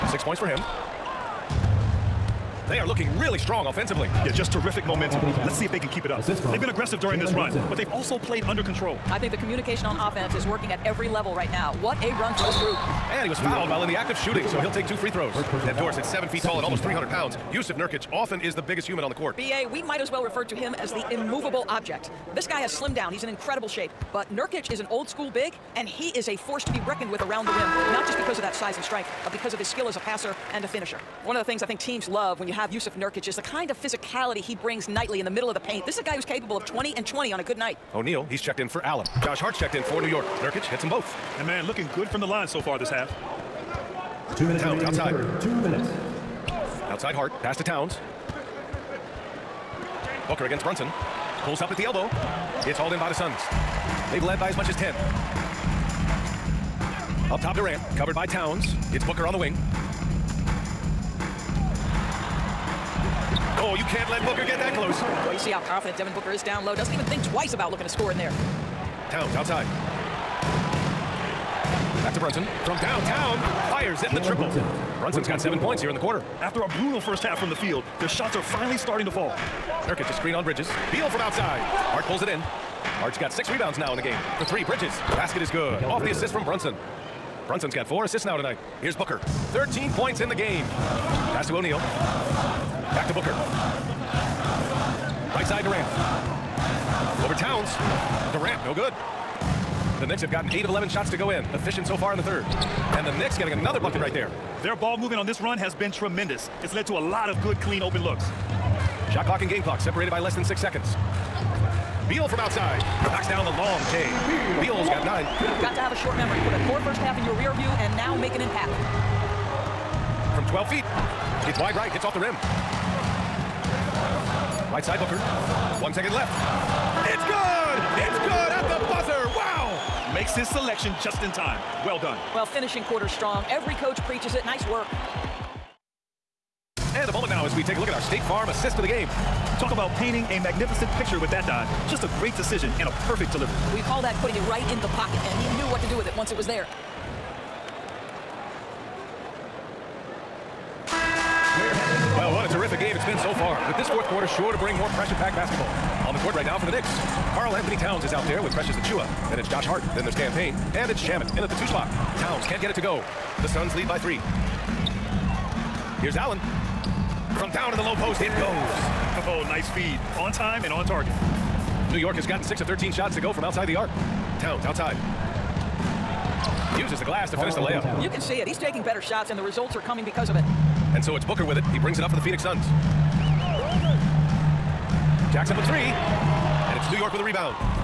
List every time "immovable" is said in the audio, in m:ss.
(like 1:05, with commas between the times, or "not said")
0:21.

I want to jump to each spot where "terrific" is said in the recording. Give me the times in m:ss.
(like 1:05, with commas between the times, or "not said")
0:04, 2:32.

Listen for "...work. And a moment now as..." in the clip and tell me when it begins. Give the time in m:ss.
2:14.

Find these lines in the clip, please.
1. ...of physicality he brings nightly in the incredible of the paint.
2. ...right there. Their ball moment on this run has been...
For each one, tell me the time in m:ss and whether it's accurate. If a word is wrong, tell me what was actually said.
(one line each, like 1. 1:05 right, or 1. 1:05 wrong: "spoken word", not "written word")
1. 0:33 wrong: "middle", not "incredible"
2. 1:44 wrong: "movement", not "moment".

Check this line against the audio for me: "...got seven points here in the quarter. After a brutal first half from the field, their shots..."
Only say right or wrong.
right.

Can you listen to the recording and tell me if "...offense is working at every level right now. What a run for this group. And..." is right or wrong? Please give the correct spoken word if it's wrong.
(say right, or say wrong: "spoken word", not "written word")
right.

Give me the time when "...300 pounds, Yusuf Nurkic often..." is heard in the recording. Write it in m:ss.
0:16.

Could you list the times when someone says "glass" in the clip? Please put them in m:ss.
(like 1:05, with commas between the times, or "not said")
2:57.